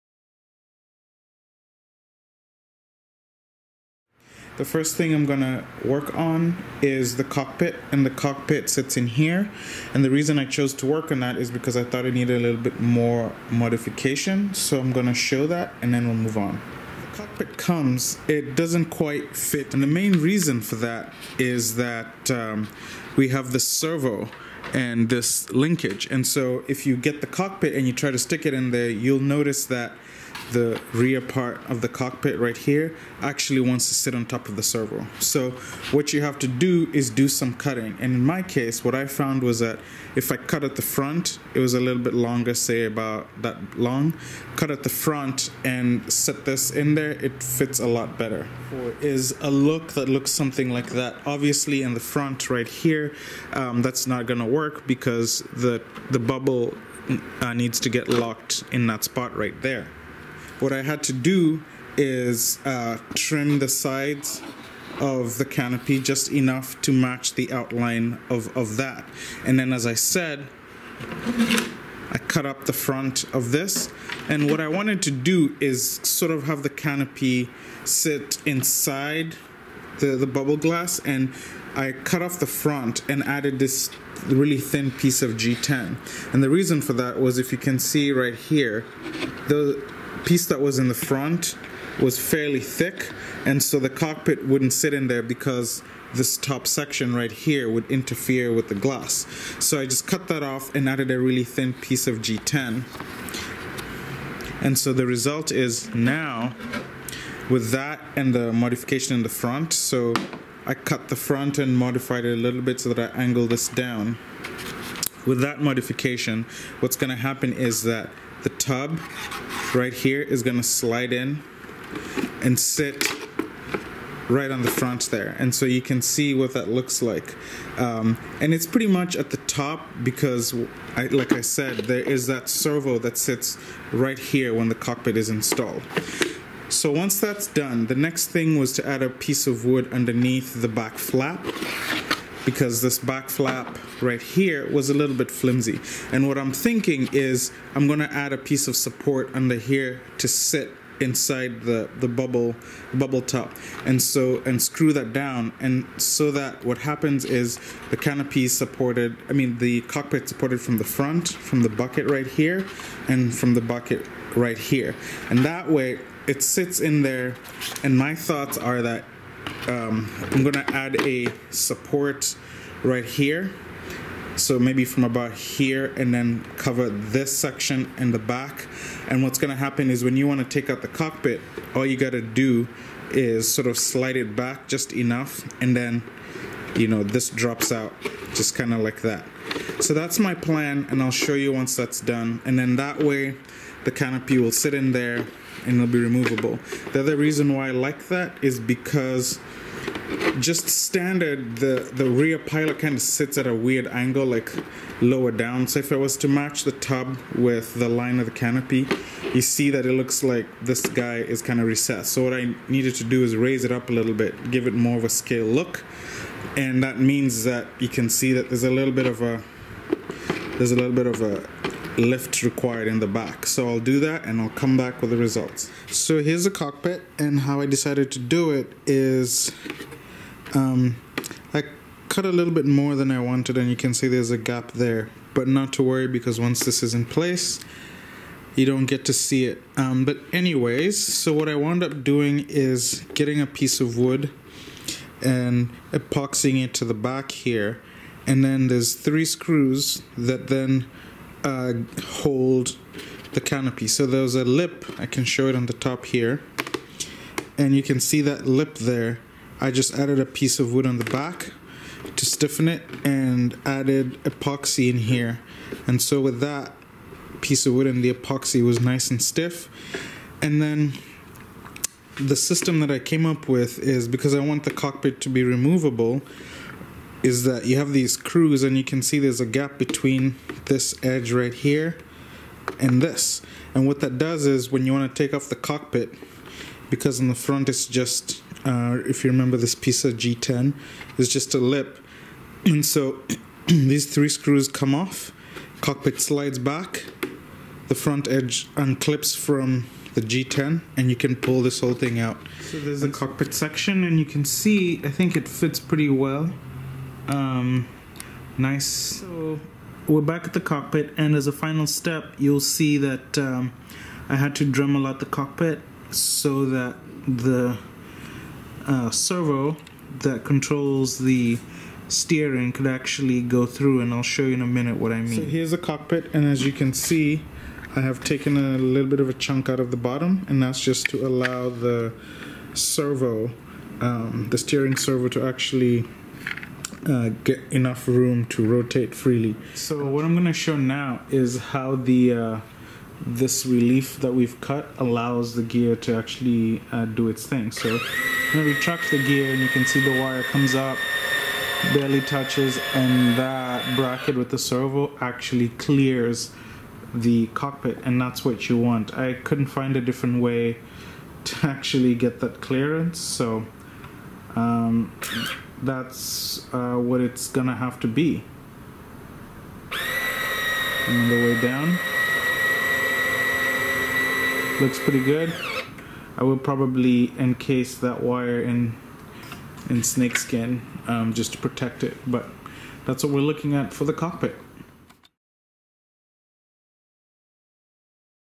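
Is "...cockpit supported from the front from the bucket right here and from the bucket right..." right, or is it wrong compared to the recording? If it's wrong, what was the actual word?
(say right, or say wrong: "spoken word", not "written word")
right.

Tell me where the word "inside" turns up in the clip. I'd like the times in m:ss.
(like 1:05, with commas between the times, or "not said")
1:18, 2:30.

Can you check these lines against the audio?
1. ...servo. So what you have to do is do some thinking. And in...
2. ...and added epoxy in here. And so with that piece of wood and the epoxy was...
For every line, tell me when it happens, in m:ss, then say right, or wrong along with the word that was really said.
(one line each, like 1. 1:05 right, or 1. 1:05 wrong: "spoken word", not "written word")
1. 0:34 wrong: "cutting", not "thinking"
2. 4:23 right.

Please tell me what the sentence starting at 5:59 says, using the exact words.
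I couldn't find a different way to actually get that clearance so um, that's uh, what it's gonna have to be.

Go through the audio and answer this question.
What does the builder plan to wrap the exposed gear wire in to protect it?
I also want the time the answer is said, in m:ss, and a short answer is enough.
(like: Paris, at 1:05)
snakeskin, at 6:20.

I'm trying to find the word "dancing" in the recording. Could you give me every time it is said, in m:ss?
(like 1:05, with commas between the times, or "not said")
not said.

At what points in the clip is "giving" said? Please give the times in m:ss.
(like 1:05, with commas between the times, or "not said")
not said.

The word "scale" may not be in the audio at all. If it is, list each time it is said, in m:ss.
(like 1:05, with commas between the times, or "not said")
3:35.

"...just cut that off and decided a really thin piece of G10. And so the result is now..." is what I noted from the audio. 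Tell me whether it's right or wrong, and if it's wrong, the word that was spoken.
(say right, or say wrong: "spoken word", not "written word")
wrong: "added", not "decided".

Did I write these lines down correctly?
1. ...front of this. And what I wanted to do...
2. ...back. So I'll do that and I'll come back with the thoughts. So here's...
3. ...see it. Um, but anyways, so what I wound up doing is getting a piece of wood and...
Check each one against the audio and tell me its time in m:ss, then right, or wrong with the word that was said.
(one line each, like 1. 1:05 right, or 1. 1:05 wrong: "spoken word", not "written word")
1. 1:12 right
2. 3:43 wrong: "results", not "thoughts"
3. 3:59 right.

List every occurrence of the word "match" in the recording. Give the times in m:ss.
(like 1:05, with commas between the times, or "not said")
1:06, 3:26.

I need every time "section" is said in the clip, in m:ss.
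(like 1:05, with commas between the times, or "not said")
1:36, 2:57, 5:03.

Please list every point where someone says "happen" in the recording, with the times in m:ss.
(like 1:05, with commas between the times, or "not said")
1:57, 2:36, 2:59.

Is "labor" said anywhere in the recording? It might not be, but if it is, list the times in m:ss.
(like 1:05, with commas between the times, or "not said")
not said.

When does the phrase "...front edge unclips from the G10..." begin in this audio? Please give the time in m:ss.
4:57.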